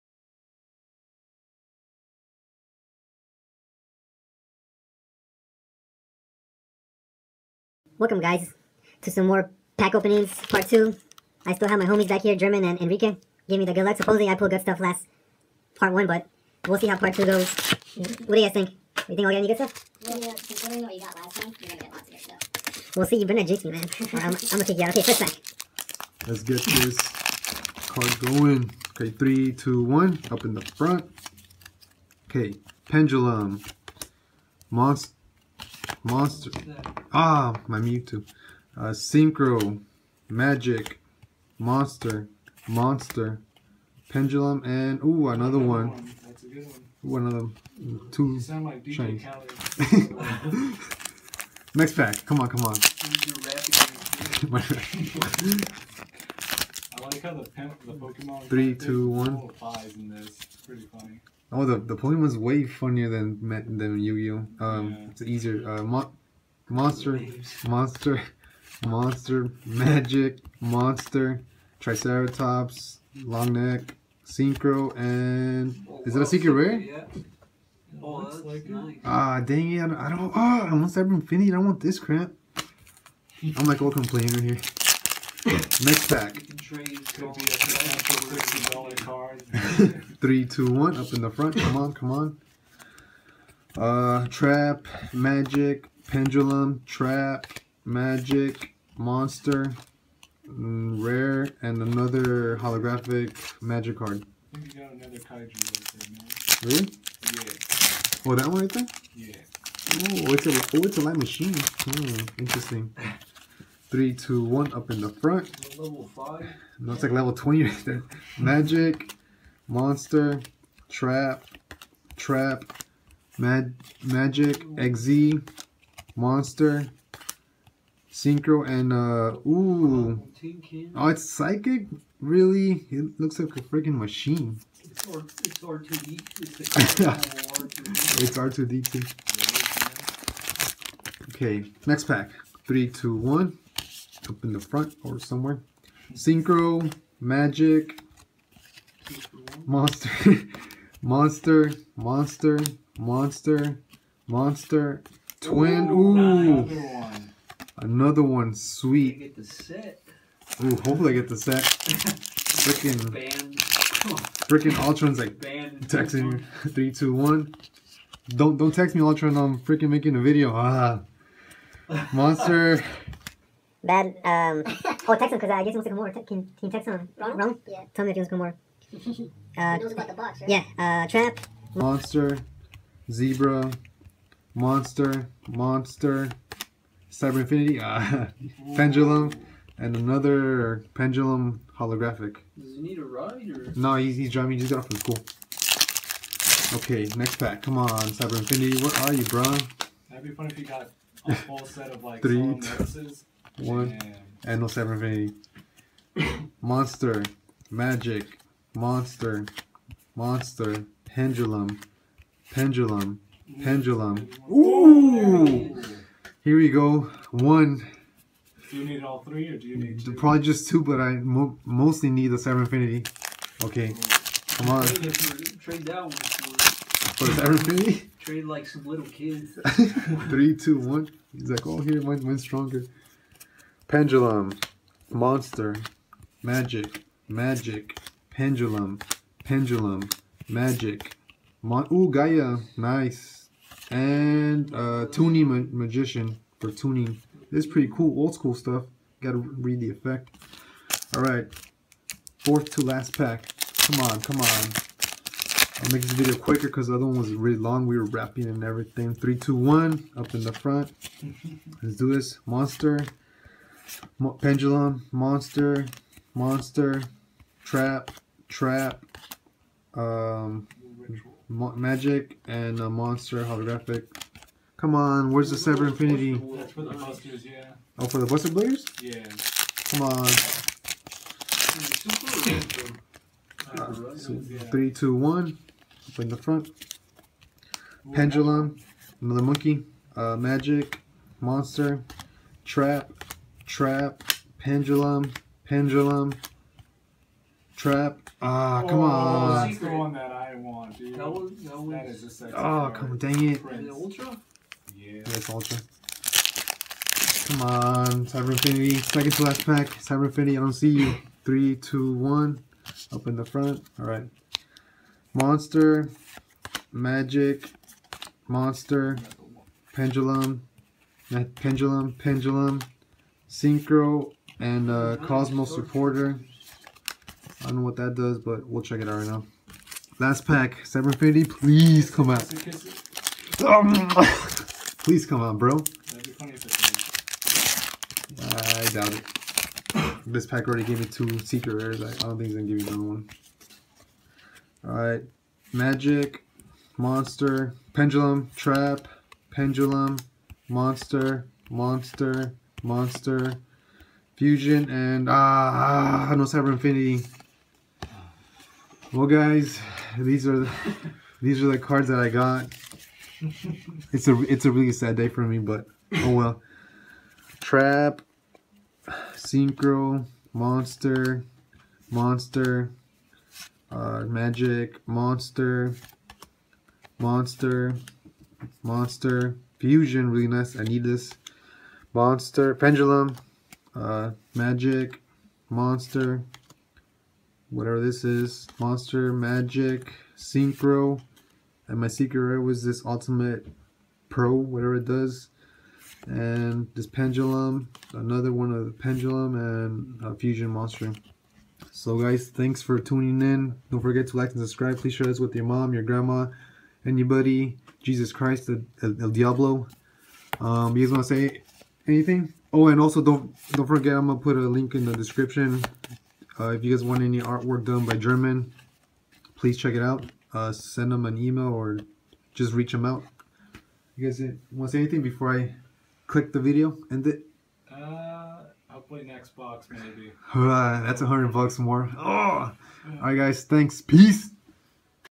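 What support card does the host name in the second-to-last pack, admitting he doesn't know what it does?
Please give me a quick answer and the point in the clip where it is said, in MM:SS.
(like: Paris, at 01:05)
Cosmos Supporter, at 05:25.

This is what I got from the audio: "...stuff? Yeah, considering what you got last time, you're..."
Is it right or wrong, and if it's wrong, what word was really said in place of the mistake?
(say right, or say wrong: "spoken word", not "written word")
right.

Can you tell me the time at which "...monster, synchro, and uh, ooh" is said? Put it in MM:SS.
02:06.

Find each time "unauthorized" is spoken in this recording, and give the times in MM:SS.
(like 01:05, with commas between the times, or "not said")
not said.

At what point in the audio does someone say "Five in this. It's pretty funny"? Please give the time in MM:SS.
00:59.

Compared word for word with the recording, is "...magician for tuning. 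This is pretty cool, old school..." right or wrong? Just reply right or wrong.
right.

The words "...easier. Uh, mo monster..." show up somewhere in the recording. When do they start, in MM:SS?
01:05.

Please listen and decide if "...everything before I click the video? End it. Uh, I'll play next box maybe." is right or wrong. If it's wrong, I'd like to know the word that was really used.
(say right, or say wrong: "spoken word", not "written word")
wrong: "anything", not "everything".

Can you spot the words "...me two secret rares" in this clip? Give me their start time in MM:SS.
05:40.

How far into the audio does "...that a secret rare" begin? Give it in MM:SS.
01:16.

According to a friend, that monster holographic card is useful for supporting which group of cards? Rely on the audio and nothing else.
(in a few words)
Buster Bladers.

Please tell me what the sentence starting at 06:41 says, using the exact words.
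So guys, thanks for tuning in.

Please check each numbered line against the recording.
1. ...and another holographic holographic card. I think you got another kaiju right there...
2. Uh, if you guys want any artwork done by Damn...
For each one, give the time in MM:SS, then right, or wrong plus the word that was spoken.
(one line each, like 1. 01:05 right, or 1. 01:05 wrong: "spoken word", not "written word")
1. 01:41 wrong: "magic", not "holographic"
2. 06:56 wrong: "German", not "Damn".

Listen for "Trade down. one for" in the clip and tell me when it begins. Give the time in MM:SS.
03:44.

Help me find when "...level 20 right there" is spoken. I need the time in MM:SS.
01:57.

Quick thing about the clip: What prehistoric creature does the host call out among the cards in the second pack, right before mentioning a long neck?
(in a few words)
Triceratops.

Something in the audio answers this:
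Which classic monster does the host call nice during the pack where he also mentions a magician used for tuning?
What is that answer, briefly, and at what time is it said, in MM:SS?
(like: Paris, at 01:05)
Gaia, at 04:02.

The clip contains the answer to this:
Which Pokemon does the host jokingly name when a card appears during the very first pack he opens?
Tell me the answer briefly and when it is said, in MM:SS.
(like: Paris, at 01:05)
Mewtwo, at 00:37.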